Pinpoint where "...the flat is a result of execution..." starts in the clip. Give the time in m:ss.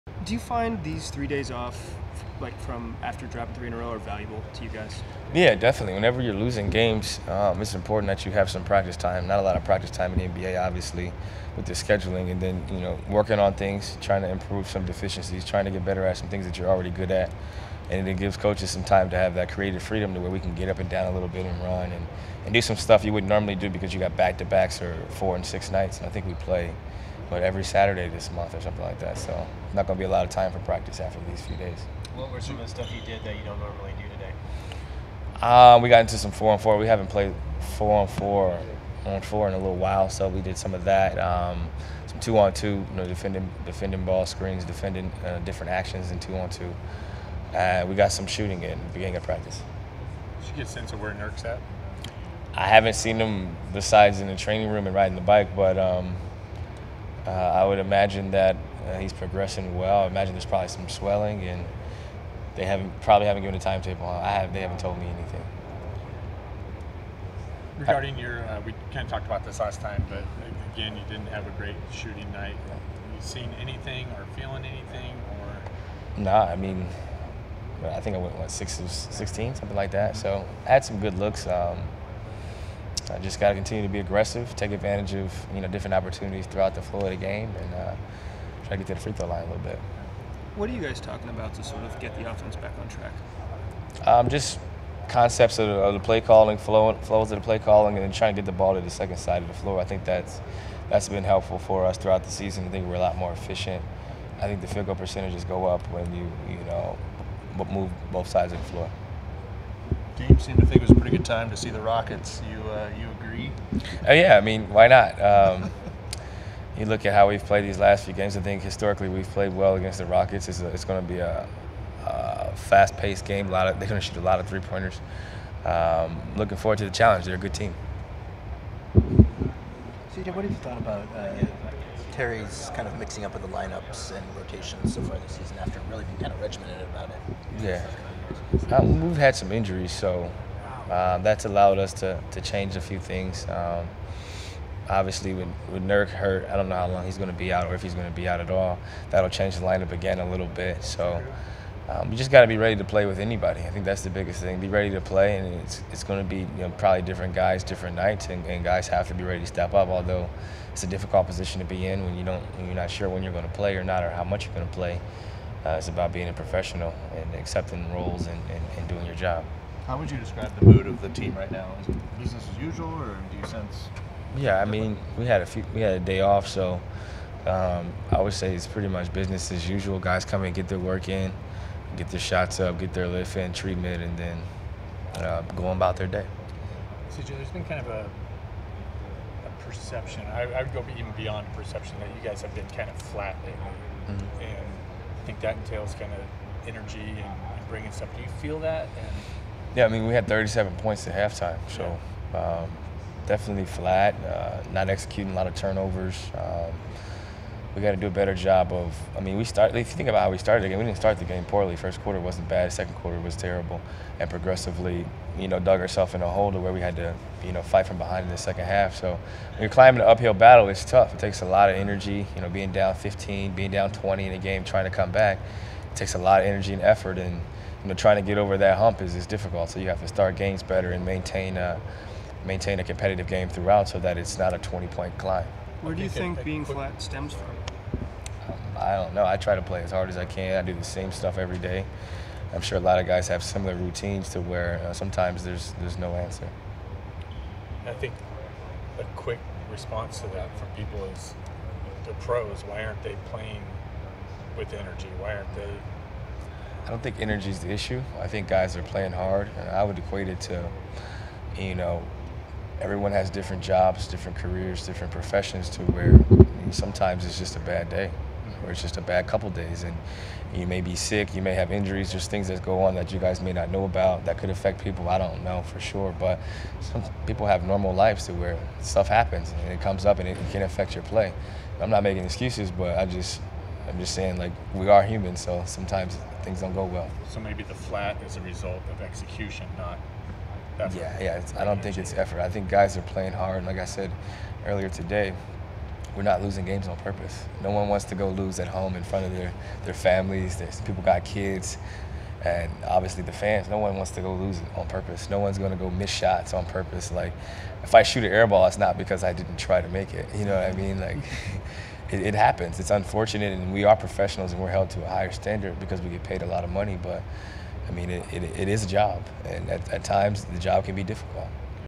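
4:47.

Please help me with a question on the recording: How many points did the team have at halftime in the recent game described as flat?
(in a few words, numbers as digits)
37.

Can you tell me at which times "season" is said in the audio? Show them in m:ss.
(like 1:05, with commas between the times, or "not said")
1:42, 2:15.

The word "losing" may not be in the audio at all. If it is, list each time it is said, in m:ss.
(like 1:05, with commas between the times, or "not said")
0:06, 4:56.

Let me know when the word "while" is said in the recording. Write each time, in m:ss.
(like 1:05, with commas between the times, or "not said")
0:39.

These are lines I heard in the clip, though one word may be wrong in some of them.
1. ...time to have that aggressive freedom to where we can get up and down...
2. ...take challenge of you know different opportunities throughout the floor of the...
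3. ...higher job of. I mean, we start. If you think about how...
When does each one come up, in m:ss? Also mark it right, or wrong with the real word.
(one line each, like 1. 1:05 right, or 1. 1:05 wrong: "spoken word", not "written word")
1. 0:18 wrong: "creative", not "aggressive"
2. 1:24 wrong: "advantage", not "challenge"
3. 3:28 wrong: "better", not "higher".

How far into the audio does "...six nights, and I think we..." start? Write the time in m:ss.
0:25.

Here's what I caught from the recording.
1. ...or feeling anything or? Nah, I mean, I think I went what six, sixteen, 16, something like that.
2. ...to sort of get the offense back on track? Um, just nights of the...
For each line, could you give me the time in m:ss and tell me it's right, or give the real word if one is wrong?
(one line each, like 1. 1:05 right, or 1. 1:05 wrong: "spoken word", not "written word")
1. 1:14 right
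2. 1:31 wrong: "concepts", not "nights".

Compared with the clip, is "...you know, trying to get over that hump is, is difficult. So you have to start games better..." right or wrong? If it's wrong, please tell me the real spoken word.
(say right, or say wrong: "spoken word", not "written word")
right.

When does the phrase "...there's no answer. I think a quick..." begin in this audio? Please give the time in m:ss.
4:05.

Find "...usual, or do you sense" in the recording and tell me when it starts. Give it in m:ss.
2:52.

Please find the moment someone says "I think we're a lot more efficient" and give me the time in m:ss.
1:42.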